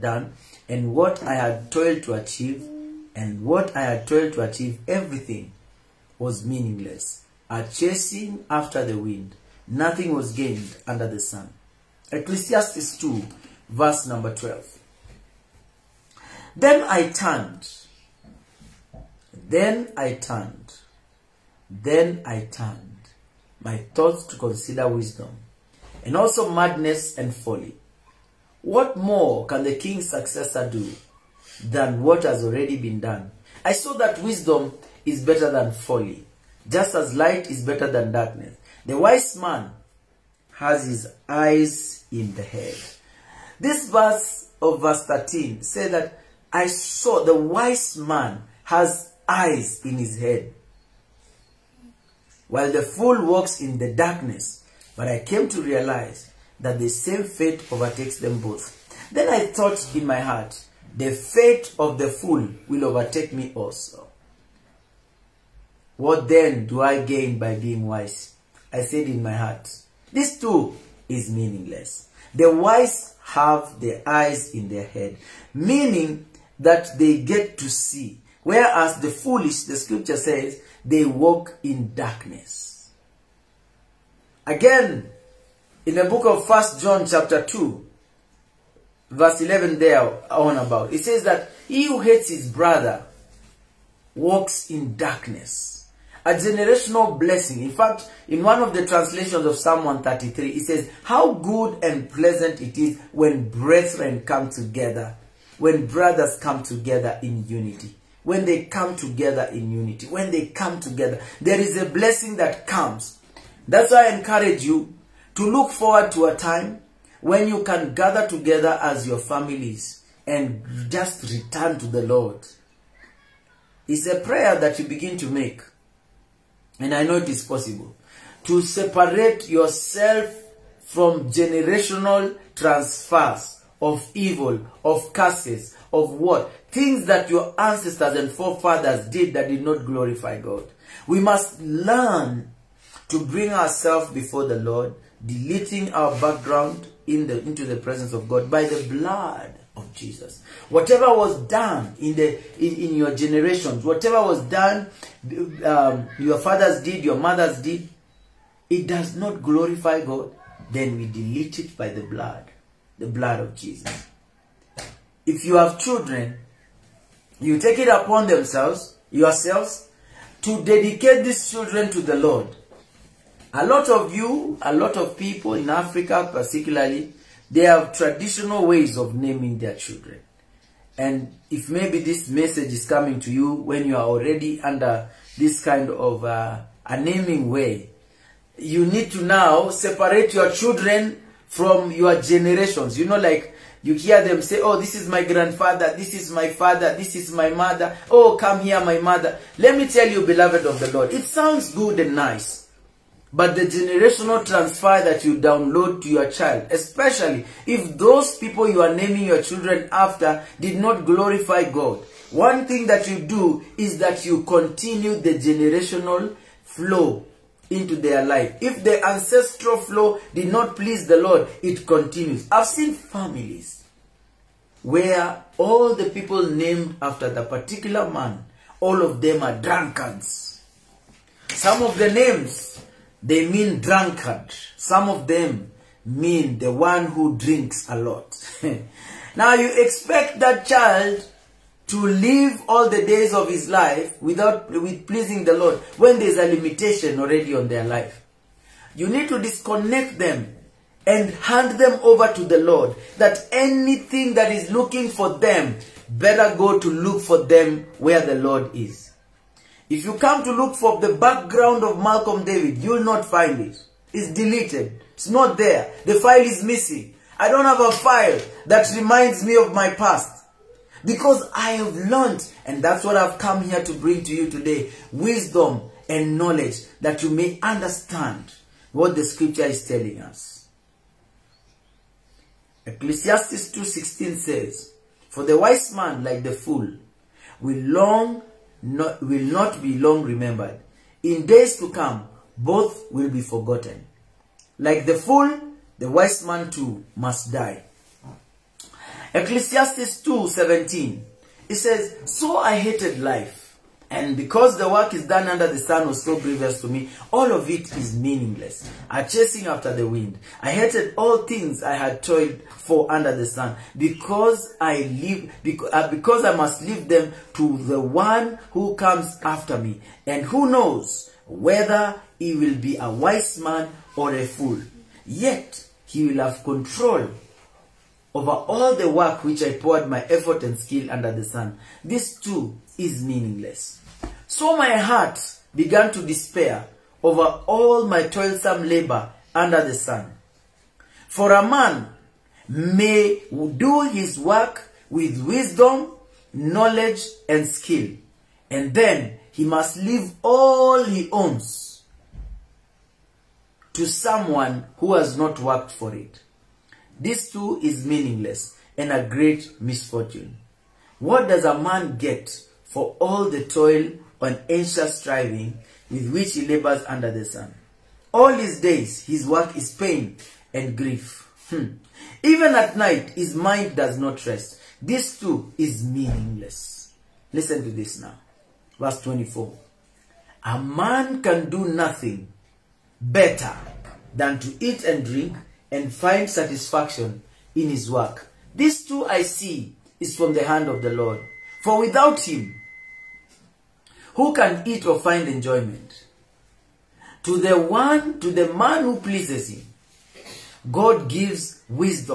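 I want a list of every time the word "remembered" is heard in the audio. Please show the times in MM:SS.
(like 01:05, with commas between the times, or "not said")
04:50.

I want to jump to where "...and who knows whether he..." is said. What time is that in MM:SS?
05:20.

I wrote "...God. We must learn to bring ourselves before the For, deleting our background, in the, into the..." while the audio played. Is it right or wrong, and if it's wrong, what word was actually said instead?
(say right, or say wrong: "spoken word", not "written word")
wrong: "Lord", not "For".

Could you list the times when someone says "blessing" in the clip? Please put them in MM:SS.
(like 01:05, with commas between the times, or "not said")
01:37, 01:51.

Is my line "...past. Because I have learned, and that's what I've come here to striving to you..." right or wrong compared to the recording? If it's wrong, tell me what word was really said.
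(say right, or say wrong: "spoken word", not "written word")
wrong: "bring", not "striving".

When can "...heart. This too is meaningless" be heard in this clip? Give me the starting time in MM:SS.
01:09.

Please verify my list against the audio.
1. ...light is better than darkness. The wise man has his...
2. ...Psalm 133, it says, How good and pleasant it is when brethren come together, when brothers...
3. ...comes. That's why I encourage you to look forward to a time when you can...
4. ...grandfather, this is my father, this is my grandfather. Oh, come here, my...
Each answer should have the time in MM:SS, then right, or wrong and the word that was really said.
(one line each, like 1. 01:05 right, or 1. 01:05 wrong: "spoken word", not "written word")
1. 00:37 right
2. 01:39 right
3. 01:52 right
4. 03:15 wrong: "mother", not "grandfather".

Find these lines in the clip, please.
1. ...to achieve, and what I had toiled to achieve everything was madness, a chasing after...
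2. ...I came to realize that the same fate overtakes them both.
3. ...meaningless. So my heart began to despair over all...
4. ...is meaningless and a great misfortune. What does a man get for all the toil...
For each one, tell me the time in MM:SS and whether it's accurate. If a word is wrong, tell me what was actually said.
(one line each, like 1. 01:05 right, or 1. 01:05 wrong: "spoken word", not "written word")
1. 00:02 wrong: "meaningless", not "madness"
2. 00:55 right
3. 05:33 right
4. 05:57 right.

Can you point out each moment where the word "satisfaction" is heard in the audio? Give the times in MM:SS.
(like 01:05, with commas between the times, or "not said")
06:26.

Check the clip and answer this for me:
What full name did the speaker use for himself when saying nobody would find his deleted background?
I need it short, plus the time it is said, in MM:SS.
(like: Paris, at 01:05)
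Malcolm David, at 04:22.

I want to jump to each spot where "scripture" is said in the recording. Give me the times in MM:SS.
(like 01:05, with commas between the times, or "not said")
01:19, 04:39.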